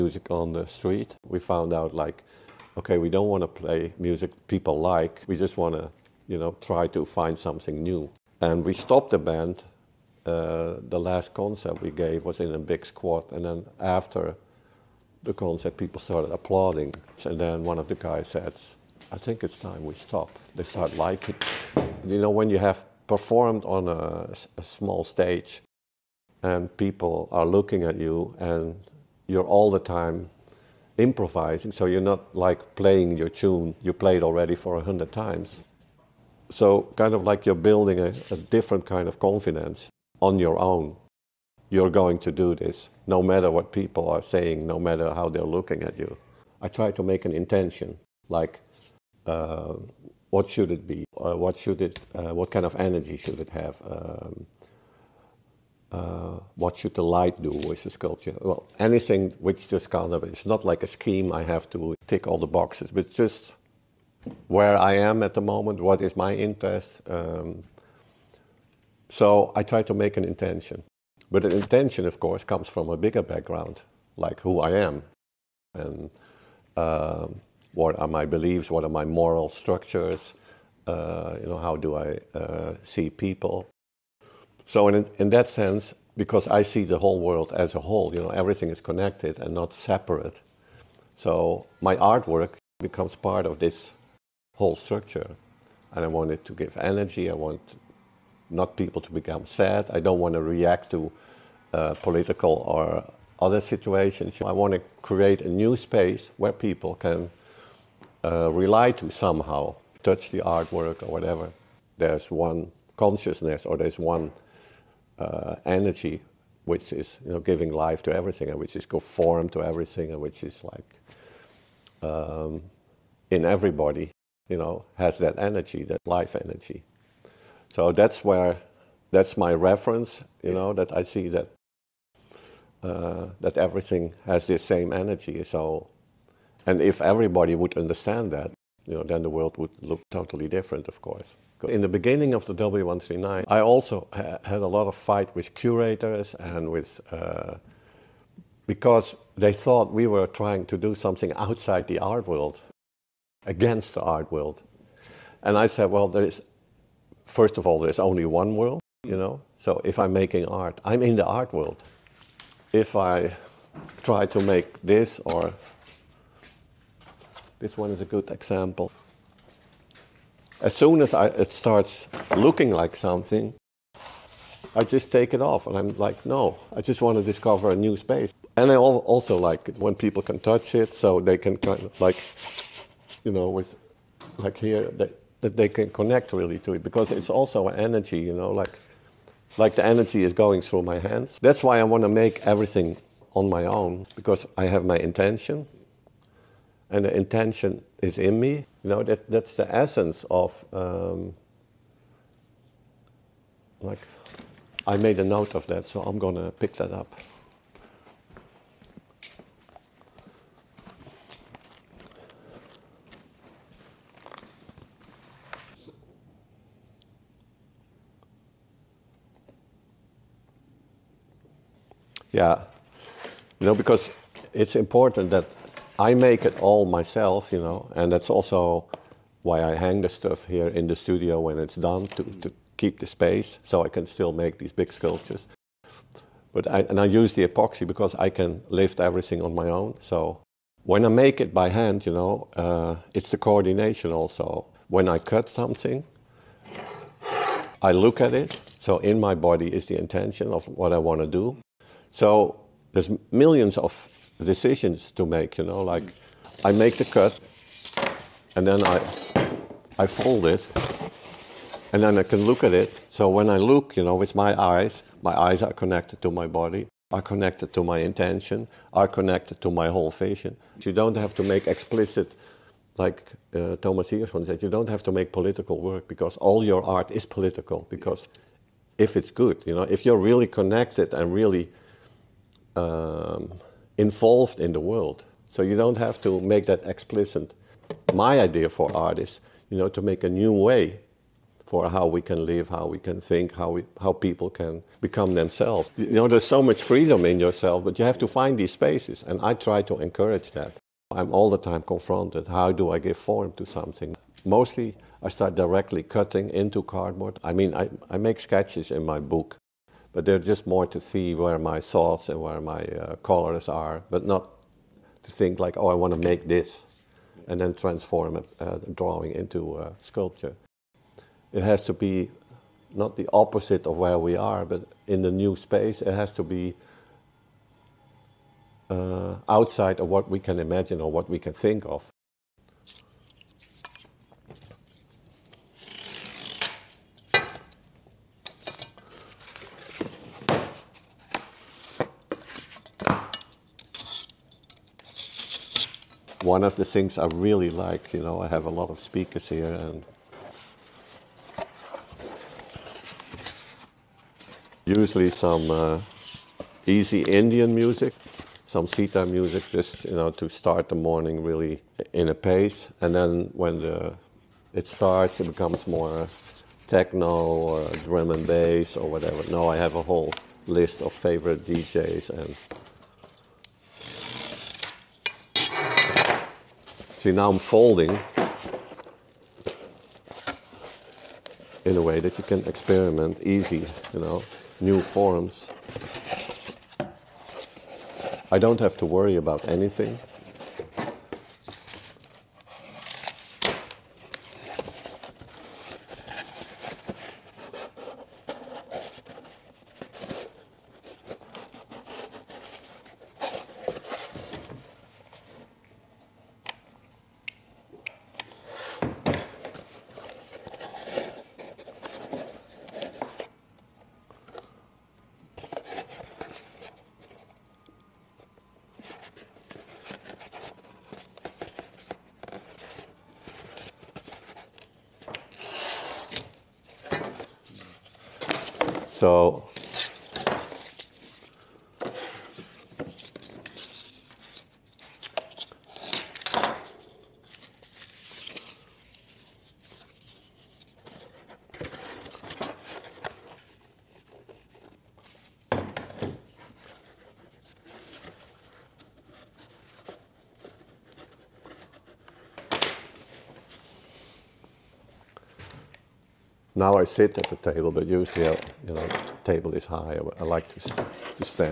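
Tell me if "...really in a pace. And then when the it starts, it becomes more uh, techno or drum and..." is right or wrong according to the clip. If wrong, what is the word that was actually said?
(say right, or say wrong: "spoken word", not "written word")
right.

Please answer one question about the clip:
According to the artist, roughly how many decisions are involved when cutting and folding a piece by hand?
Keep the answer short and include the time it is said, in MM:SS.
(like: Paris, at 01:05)
Millions, at 04:13.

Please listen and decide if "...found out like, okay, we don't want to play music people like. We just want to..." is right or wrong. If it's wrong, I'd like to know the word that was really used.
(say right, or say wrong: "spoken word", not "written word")
right.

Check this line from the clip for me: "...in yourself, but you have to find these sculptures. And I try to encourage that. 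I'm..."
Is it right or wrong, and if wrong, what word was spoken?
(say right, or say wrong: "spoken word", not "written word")
wrong: "spaces", not "sculptures".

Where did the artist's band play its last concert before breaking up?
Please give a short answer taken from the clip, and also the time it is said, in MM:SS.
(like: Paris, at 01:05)
A big squat, at 00:12.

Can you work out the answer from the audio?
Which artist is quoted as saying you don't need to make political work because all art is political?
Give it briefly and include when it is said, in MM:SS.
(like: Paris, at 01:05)
Thomas Hirschhorn, at 04:33.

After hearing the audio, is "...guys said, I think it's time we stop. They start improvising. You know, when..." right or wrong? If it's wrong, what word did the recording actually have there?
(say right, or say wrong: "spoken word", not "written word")
wrong: "liking", not "improvising".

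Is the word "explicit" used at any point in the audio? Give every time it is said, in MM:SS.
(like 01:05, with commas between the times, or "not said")
04:31, 04:46.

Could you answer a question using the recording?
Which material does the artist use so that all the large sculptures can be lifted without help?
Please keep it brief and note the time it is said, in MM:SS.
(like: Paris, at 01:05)
Epoxy, at 03:57.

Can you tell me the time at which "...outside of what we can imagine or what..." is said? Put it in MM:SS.
05:29.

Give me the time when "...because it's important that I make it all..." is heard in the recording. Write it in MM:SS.
03:43.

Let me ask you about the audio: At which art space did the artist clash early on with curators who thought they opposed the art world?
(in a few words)
W139.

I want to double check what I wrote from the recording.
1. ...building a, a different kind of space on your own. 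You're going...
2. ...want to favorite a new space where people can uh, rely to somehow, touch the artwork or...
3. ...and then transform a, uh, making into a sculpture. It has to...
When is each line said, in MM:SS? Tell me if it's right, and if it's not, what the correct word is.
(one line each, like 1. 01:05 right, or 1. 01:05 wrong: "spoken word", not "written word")
1. 00:37 wrong: "confidence", not "space"
2. 01:44 wrong: "create", not "favorite"
3. 05:17 wrong: "drawing", not "making".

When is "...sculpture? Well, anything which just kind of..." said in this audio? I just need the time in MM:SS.
00:57.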